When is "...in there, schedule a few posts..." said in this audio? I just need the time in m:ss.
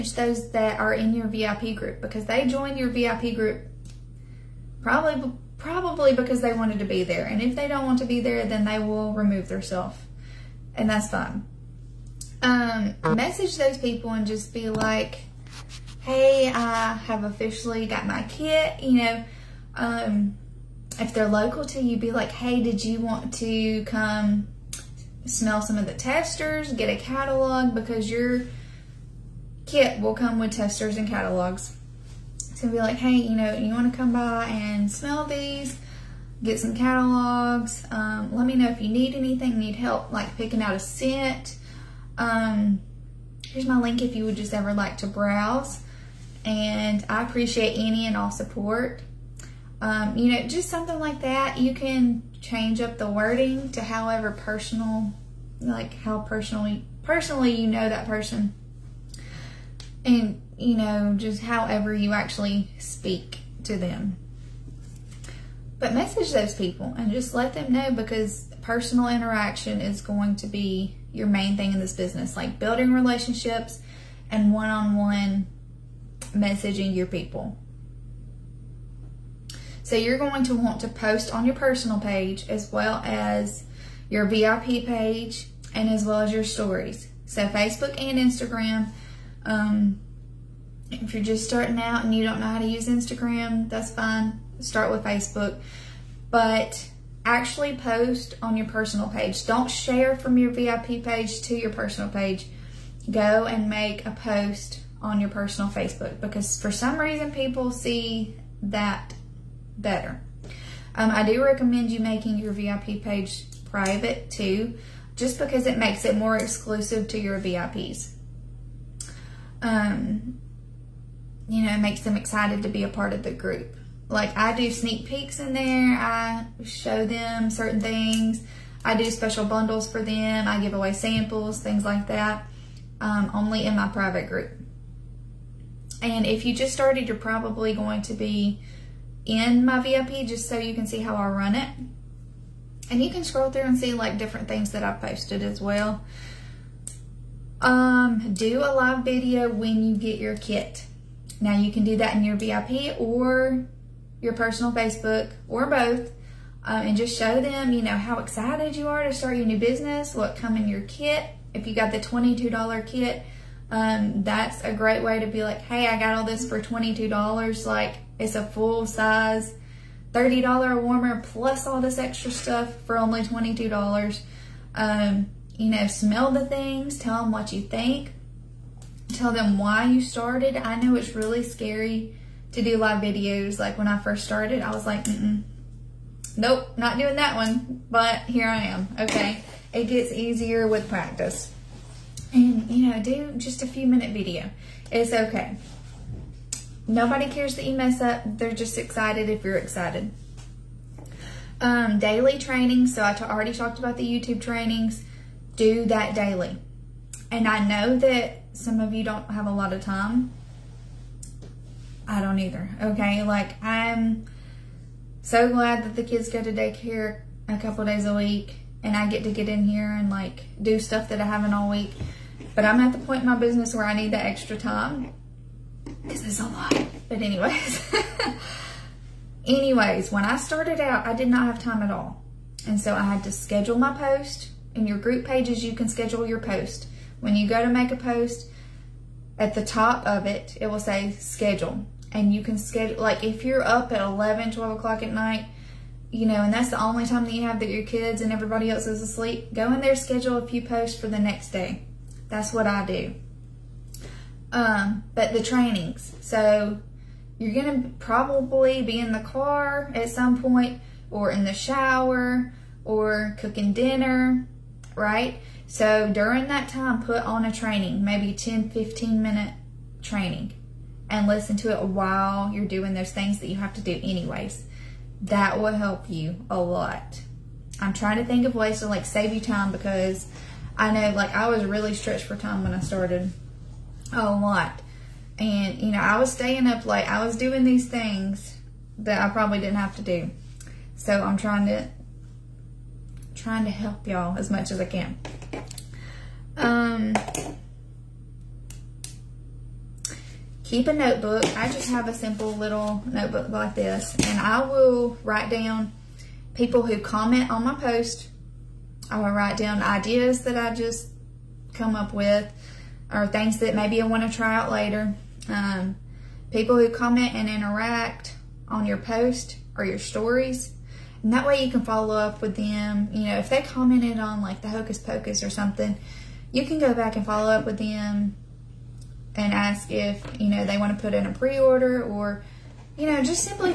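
4:09.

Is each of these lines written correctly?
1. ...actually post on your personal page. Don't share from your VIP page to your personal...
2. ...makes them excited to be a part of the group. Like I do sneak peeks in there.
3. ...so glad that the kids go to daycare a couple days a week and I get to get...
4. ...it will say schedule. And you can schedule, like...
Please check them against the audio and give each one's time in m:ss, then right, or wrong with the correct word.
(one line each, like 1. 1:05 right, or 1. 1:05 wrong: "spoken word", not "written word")
1. 1:37 right
2. 2:01 right
3. 3:35 right
4. 4:00 right.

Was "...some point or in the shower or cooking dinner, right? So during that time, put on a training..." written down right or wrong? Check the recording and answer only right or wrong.
right.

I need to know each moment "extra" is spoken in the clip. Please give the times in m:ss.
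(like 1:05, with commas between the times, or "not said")
2:51, 3:44.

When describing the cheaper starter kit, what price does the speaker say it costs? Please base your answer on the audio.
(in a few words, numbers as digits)
$22.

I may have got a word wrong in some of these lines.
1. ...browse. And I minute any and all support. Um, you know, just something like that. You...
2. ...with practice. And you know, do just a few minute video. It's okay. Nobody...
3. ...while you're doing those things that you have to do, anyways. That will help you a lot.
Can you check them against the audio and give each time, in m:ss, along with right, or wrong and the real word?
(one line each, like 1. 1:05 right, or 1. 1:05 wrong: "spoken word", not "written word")
1. 0:45 wrong: "appreciate", not "minute"
2. 3:10 right
3. 4:31 right.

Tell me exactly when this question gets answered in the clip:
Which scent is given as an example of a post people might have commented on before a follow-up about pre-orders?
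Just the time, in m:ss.
5:24.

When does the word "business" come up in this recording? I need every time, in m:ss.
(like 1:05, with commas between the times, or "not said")
1:11, 2:39, 3:43.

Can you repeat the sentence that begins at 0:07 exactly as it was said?
And if they don't want to be there, then they will remove themselves.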